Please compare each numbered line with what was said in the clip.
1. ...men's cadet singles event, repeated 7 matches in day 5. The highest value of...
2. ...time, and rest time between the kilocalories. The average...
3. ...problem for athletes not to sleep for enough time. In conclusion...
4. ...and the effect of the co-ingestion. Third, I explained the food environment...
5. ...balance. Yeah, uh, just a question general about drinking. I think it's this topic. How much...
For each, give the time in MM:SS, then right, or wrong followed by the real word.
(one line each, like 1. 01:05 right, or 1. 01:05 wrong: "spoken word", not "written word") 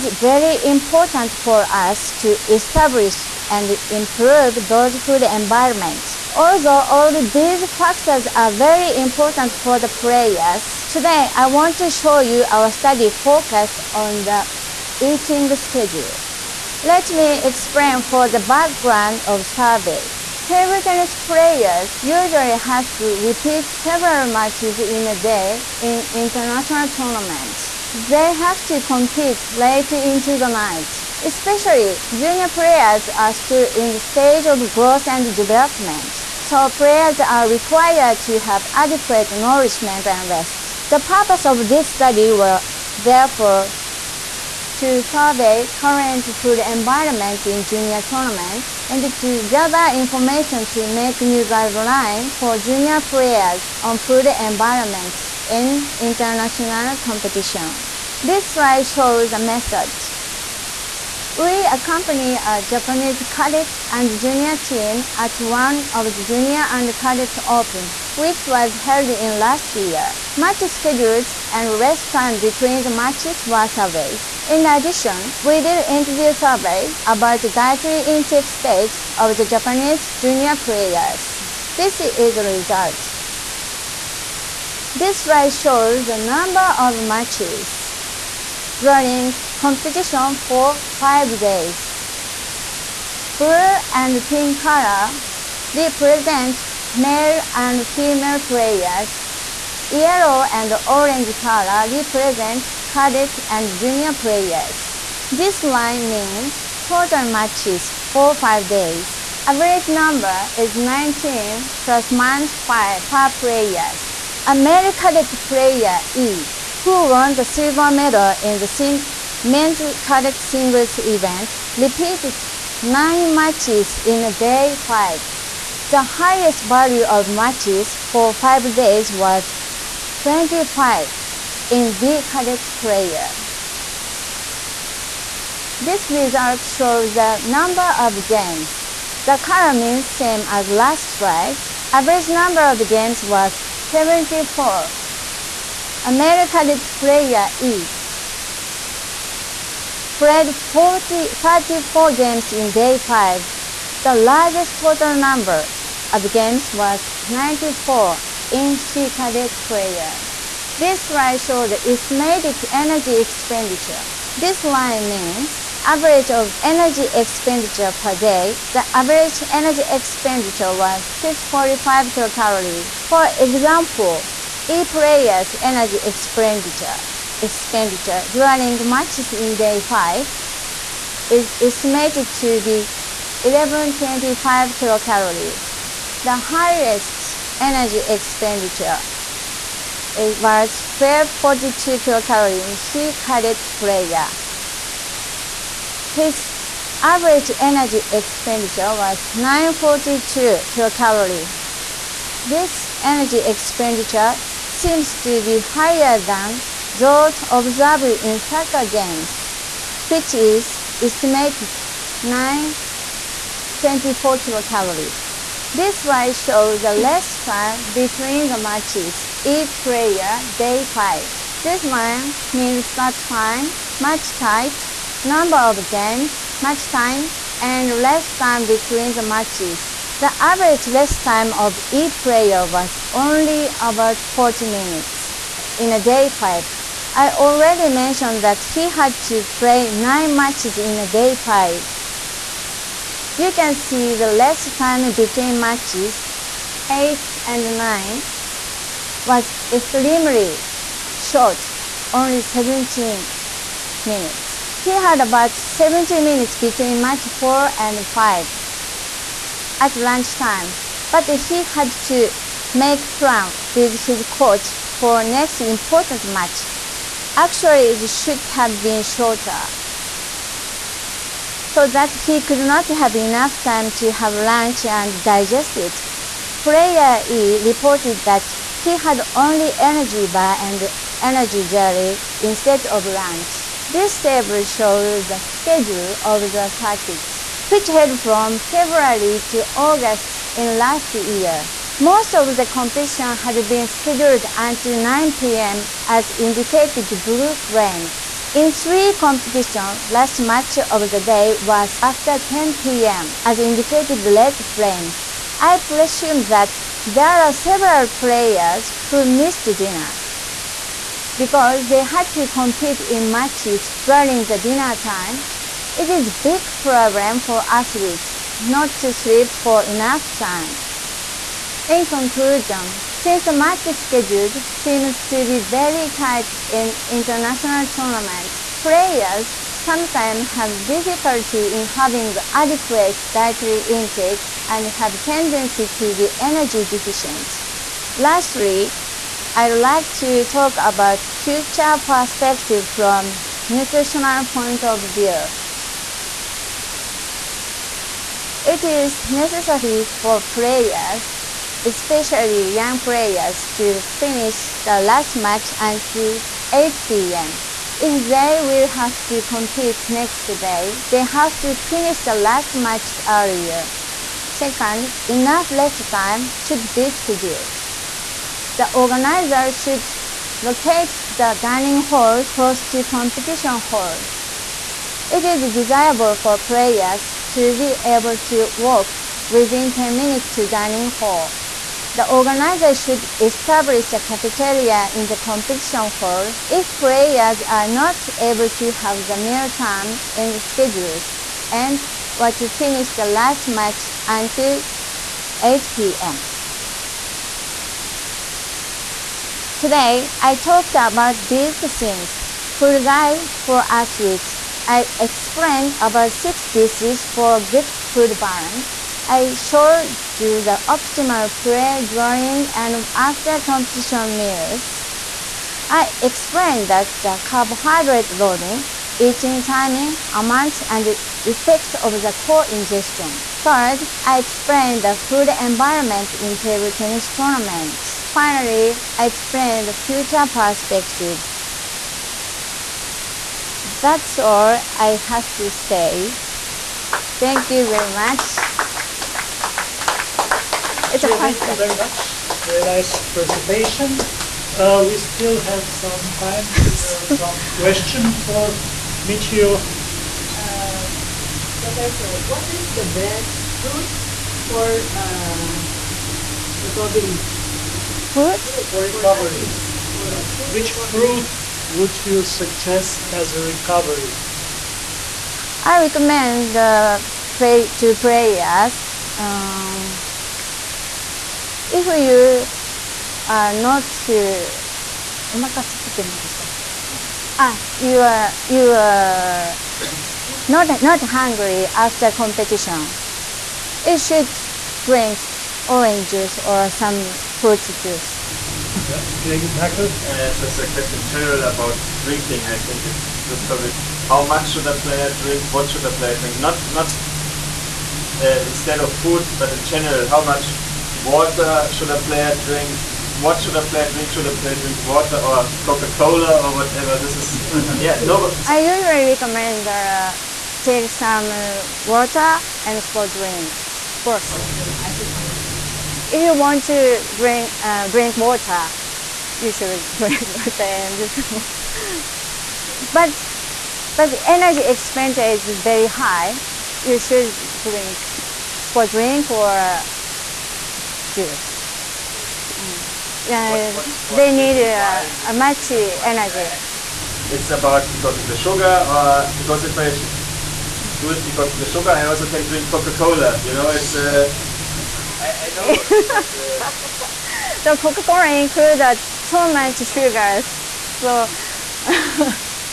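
1. 01:59 wrong: "9", not "7"
2. 03:46 wrong: "matches", not "kilocalories"
3. 05:16 right
4. 07:00 right
5. 08:07 wrong: "juice", not "balance".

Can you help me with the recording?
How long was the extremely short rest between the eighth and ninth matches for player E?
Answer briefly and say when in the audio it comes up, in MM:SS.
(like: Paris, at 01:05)
17 minutes, at 04:12.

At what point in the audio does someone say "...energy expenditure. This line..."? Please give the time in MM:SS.
02:42.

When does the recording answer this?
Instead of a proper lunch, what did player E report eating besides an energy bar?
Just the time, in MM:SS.
04:41.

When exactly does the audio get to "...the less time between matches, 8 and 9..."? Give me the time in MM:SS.
04:04.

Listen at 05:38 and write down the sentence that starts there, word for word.
Lastly, I'd like to talk about future perspective from nutritional point of view.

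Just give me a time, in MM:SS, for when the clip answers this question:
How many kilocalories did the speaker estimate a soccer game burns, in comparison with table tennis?
03:32.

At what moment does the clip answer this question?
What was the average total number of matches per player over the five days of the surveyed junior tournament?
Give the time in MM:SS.
01:50.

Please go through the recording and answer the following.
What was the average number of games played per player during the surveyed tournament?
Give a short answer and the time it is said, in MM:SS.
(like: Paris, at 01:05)
74, at 02:23.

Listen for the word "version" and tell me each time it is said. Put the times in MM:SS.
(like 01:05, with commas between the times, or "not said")
not said.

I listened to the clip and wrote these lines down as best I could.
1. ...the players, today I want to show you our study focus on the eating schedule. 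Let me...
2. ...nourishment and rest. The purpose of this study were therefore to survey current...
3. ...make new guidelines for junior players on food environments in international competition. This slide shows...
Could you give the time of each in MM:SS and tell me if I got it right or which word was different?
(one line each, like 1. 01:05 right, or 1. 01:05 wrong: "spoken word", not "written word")
1. 00:09 right
2. 00:39 right
3. 00:50 right.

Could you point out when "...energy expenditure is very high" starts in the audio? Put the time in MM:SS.
08:44.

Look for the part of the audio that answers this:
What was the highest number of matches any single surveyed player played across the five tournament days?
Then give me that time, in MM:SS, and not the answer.
02:10.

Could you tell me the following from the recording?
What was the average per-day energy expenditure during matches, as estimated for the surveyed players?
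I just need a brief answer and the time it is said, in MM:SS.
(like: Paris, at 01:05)
645 kilocalories, at 02:51.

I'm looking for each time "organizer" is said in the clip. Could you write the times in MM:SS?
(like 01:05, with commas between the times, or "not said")
06:08, 06:22.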